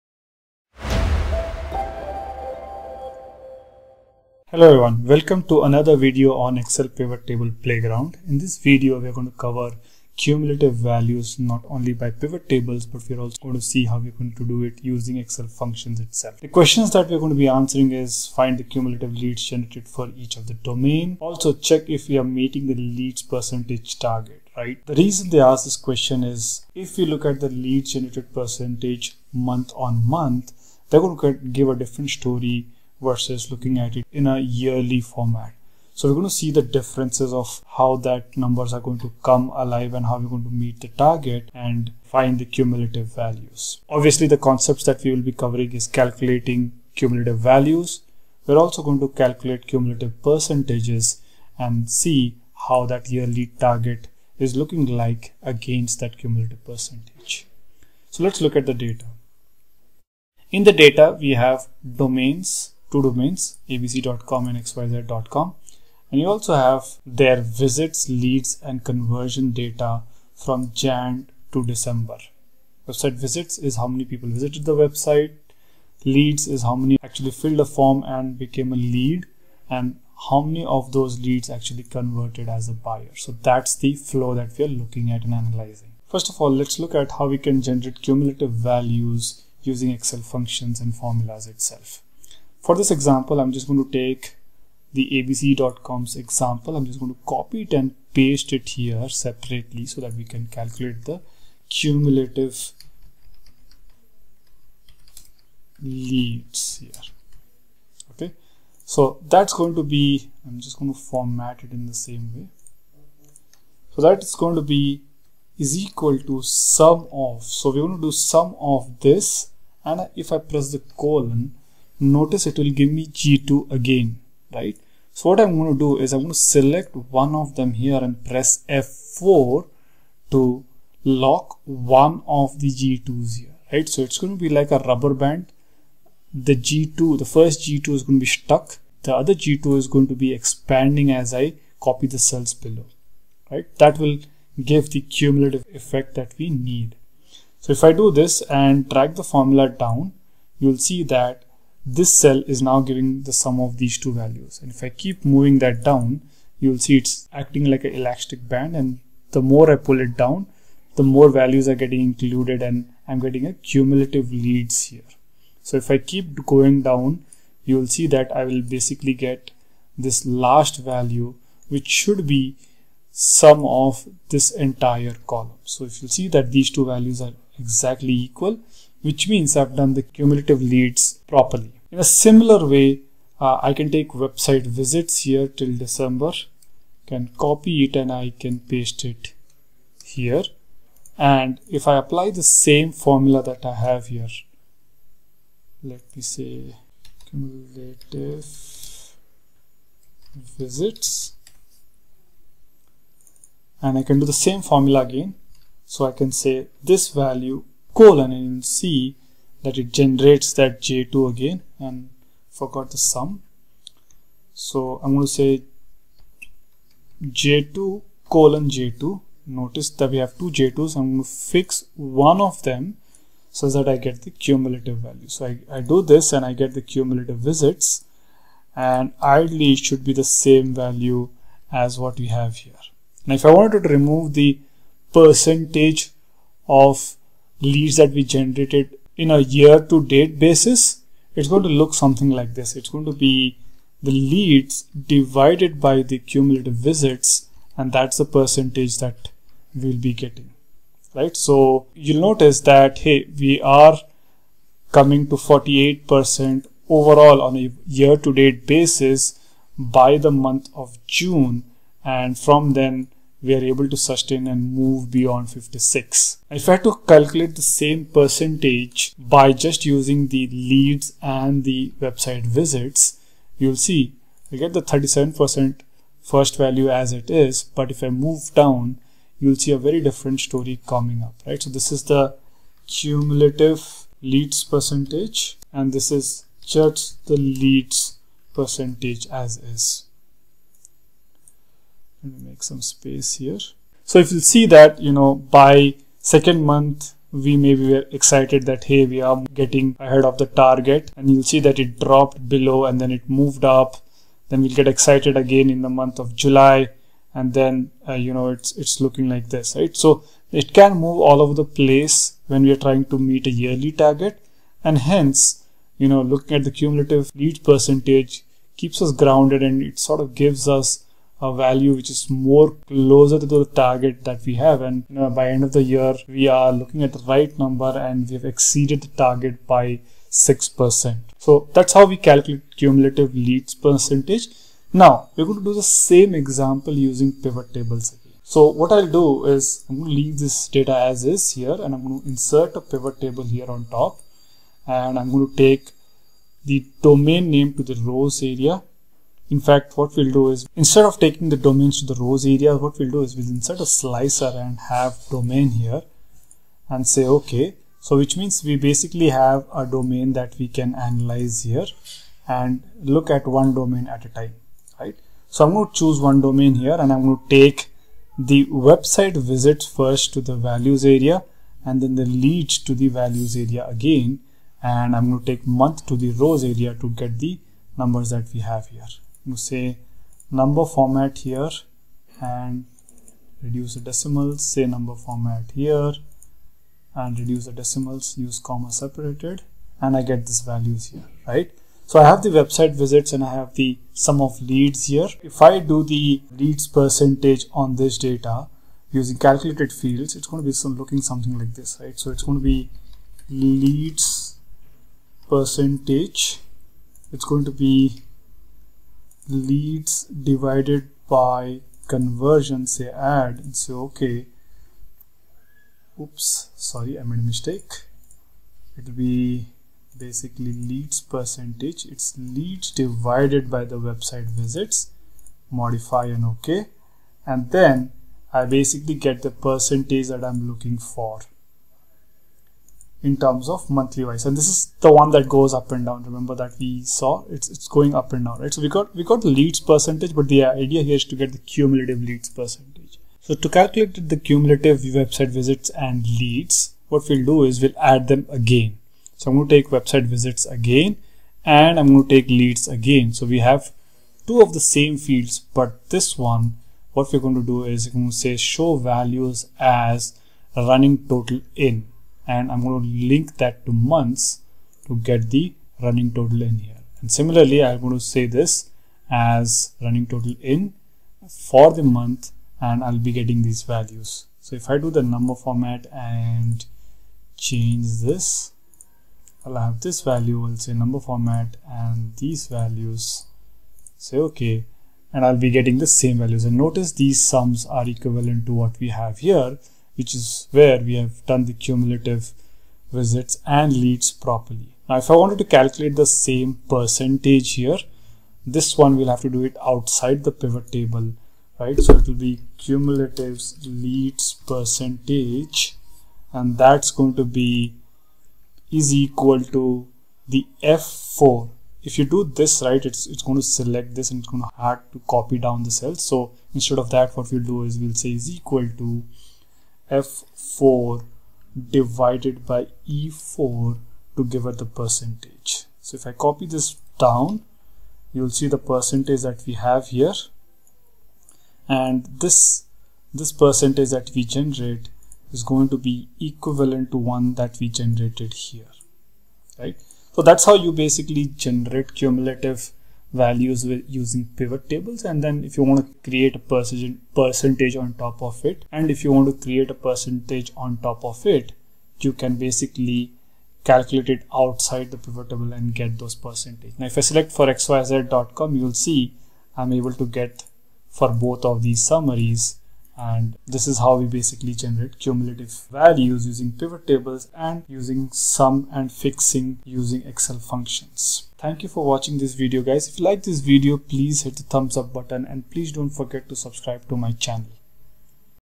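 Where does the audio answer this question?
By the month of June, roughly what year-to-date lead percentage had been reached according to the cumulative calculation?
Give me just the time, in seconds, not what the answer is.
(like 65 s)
255 s.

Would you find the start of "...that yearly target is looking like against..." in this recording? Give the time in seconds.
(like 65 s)
52 s.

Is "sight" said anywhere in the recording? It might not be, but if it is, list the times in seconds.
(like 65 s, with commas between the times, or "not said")
not said.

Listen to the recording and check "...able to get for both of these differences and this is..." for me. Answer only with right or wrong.
wrong.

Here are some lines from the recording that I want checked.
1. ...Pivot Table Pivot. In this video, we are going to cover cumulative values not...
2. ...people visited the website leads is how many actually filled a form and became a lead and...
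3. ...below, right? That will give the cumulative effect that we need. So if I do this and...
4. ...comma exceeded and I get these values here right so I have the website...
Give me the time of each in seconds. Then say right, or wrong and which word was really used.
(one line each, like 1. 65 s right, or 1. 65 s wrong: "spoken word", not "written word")
1. 6 s wrong: "Playground", not "Pivot"
2. 74 s right
3. 142 s right
4. 388 s wrong: "separated", not "exceeded".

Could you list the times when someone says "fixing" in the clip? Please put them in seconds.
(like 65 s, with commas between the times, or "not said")
569 s.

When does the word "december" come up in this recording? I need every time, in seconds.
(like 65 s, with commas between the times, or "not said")
71 s, 185 s.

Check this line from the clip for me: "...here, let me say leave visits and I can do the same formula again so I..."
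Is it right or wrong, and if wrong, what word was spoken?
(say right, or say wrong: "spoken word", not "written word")
wrong: "cumulative", not "leave".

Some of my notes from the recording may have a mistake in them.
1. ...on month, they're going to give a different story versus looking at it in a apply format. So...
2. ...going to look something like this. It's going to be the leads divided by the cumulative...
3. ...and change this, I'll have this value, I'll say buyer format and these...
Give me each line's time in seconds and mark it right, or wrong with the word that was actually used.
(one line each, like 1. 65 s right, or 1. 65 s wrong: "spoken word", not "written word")
1. 29 s wrong: "yearly", not "apply"
2. 241 s right
3. 476 s wrong: "number", not "buyer".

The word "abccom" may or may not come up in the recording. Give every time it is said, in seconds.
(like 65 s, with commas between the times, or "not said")
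63 s, 95 s.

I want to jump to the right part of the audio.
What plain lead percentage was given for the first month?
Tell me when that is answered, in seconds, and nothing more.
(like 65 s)
274 s.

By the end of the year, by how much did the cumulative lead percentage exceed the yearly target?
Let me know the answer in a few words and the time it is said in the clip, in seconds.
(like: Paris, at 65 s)
6%, at 330 s.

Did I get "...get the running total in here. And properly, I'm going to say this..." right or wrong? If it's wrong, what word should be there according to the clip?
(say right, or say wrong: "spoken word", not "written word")
wrong: "similarly", not "properly".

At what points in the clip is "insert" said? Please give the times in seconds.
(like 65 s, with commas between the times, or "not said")
342 s, 353 s.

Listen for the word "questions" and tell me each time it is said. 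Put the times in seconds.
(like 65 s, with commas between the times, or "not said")
16 s, 25 s.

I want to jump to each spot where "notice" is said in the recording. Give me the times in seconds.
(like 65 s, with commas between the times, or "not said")
122 s, 219 s, 252 s, 486 s.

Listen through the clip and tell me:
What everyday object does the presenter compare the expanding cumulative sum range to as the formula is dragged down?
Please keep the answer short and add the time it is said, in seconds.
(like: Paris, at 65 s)
elastic band, at 157 s.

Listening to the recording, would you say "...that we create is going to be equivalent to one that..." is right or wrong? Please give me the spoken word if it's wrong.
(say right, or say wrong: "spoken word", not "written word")
wrong: "generate", not "create".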